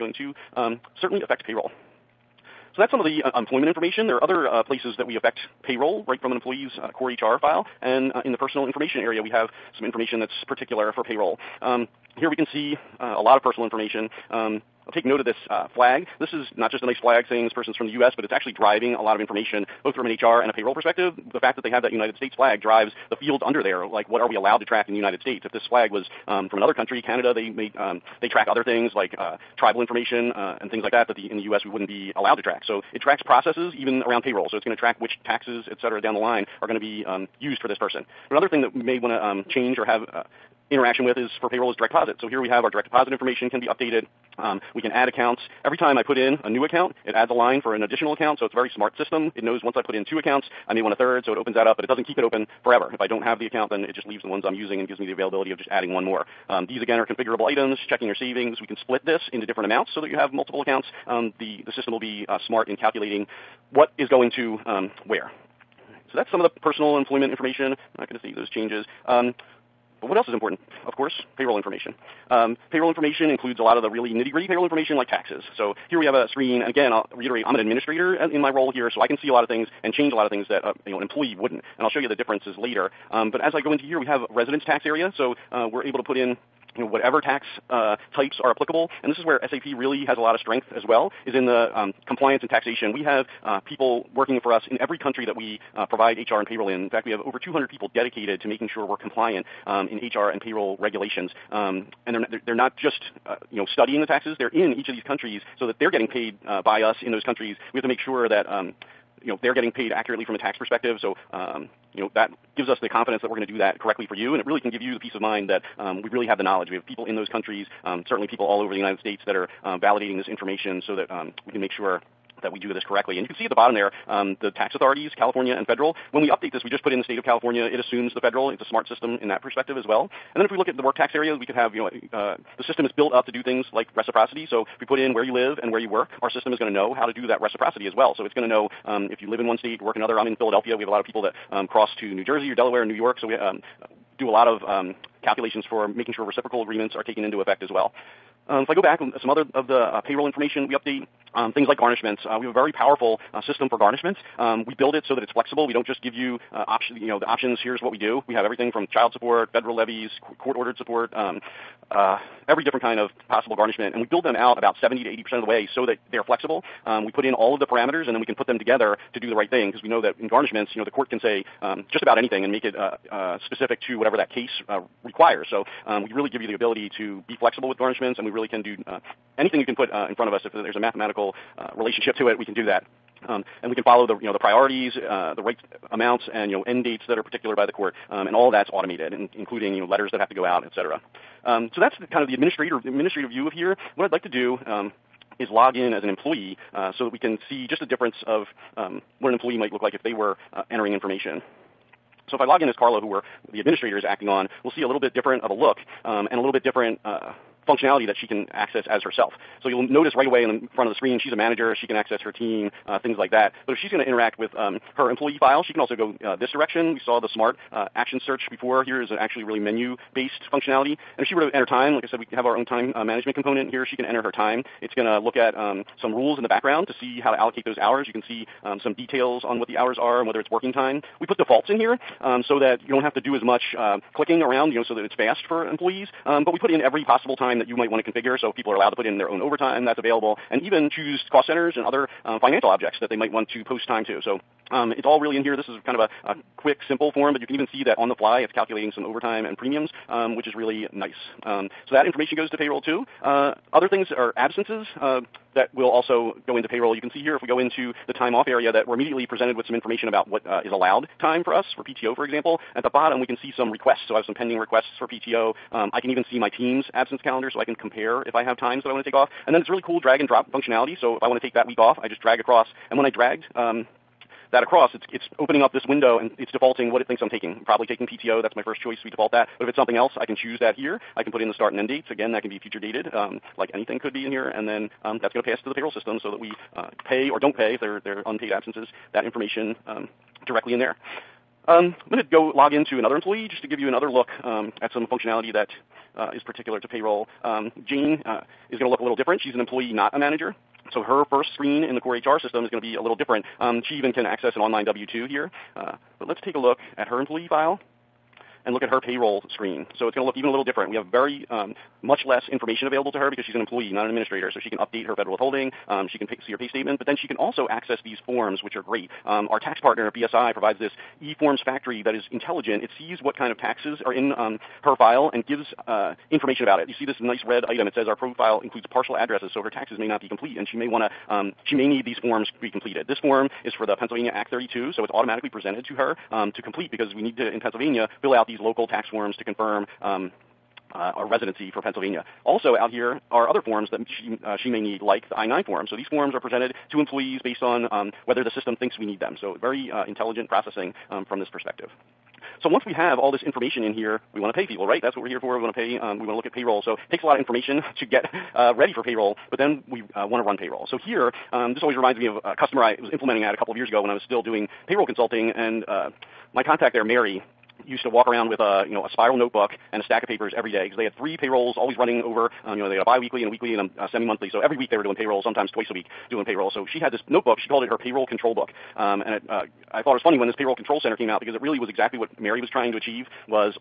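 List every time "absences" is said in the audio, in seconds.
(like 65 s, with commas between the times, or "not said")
254 s, 266 s, 288 s.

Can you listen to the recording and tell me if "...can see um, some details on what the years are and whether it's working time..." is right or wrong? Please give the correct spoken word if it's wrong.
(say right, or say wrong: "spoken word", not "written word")
wrong: "hours", not "years".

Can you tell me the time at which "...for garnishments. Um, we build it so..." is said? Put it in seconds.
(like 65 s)
153 s.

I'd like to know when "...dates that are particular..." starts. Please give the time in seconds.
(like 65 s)
186 s.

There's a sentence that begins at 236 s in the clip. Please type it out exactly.
Um, but we put in every possible time that you might want to configure.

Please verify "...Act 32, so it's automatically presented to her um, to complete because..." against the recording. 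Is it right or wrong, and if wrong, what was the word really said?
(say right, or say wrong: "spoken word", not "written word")
right.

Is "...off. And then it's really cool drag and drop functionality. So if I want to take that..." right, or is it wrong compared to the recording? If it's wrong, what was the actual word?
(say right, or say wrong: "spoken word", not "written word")
right.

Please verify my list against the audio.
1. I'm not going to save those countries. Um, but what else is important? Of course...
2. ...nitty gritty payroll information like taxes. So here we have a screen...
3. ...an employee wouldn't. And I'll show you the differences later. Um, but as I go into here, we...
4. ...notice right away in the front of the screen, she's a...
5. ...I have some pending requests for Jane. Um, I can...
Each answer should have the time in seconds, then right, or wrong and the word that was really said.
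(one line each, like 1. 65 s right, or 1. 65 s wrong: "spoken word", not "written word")
1. 67 s wrong: "changes", not "countries"
2. 74 s right
3. 80 s right
4. 209 s right
5. 264 s wrong: "PTO", not "Jane".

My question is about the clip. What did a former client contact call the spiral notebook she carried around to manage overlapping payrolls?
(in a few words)
payroll control book.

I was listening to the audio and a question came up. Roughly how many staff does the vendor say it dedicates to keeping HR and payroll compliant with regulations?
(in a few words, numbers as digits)
over 200.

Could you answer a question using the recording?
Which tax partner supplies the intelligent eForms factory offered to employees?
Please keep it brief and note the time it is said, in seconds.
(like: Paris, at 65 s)
BSI, at 320 s.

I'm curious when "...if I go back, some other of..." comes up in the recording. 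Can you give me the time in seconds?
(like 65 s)
148 s.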